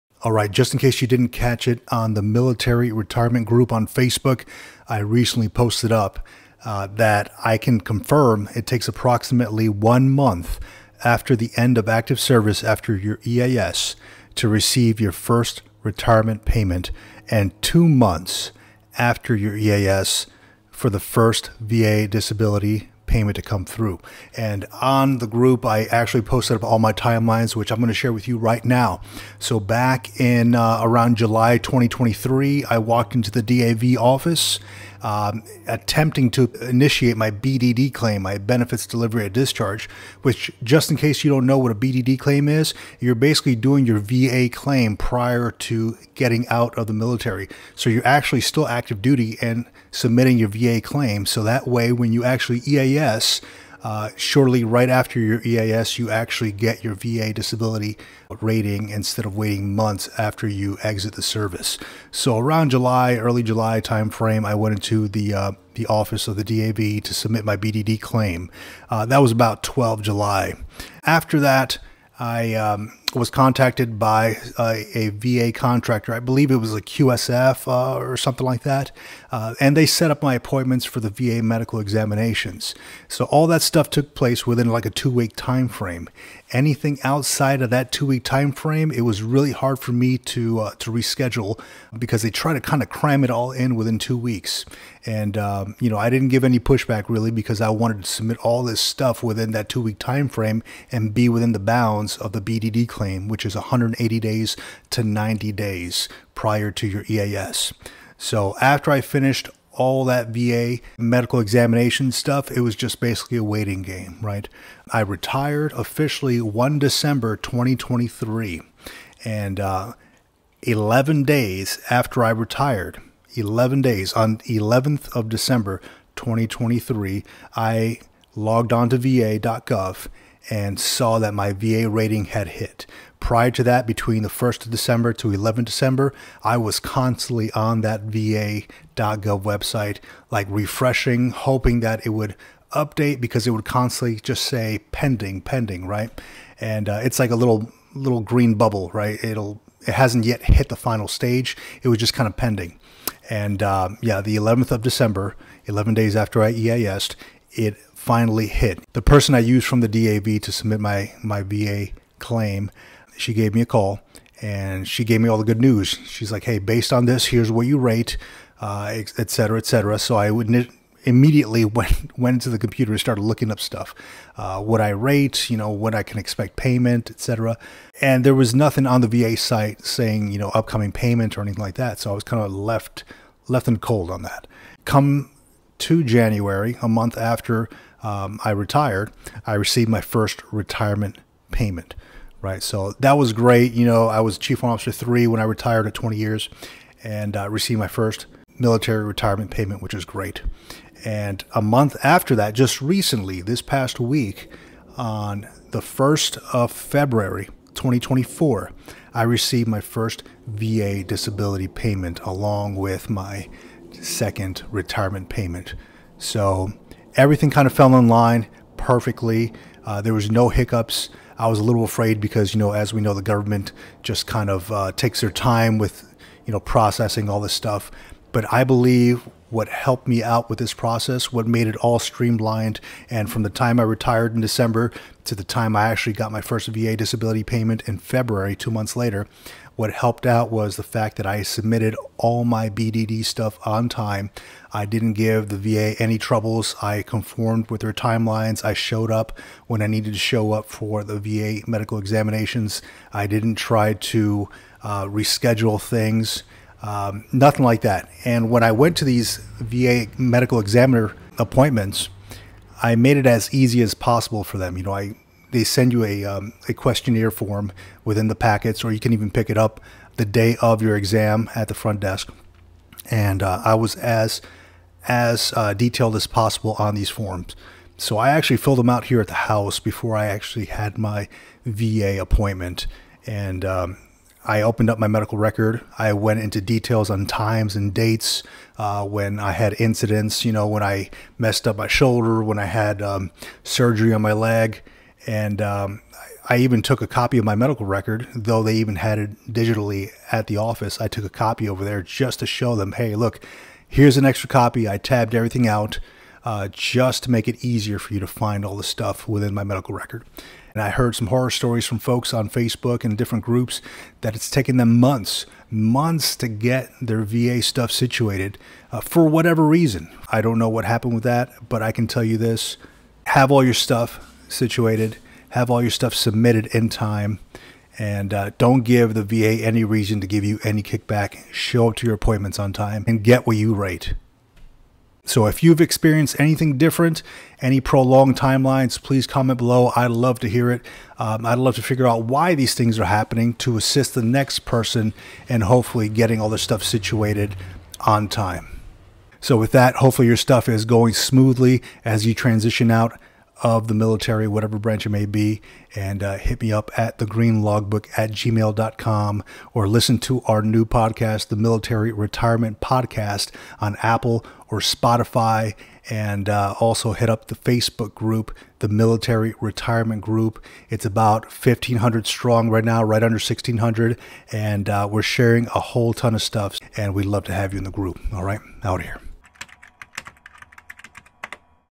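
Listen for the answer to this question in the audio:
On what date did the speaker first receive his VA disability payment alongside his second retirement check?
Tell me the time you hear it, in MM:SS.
03:25.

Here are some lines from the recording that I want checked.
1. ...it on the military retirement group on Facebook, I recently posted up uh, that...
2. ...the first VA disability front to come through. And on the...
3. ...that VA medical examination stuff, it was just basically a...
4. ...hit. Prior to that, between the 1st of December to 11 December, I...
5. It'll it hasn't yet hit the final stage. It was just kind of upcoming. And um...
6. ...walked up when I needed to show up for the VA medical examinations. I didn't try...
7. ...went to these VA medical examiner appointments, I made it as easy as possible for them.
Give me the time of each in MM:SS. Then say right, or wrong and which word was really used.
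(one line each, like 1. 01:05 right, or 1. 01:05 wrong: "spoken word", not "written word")
1. 00:01 right
2. 00:20 wrong: "payment", not "front"
3. 01:50 right
4. 02:12 right
5. 02:29 wrong: "pending", not "upcoming"
6. 04:08 wrong: "showed", not "walked"
7. 04:18 right.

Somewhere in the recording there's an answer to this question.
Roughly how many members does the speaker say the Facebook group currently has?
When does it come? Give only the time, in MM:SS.
06:11.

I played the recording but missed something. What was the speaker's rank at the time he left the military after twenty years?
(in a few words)
Chief Warrant Officer three.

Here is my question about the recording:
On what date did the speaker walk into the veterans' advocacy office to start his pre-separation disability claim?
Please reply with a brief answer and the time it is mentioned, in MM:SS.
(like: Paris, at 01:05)
12 July, at 01:09.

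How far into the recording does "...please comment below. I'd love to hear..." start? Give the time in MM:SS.
05:39.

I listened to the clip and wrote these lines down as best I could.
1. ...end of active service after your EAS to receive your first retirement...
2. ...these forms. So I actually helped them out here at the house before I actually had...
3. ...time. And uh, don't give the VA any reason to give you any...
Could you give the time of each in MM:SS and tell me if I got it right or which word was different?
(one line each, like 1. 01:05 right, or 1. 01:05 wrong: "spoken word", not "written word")
1. 00:11 right
2. 04:36 wrong: "filled", not "helped"
3. 05:26 right.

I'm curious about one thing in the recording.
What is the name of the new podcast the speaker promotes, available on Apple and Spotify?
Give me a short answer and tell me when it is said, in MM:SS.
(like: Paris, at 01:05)
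Military Retirement Podcast, at 06:01.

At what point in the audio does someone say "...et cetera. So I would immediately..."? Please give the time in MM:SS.
02:49.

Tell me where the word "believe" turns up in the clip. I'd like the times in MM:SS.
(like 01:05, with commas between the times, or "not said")
01:16, 03:48.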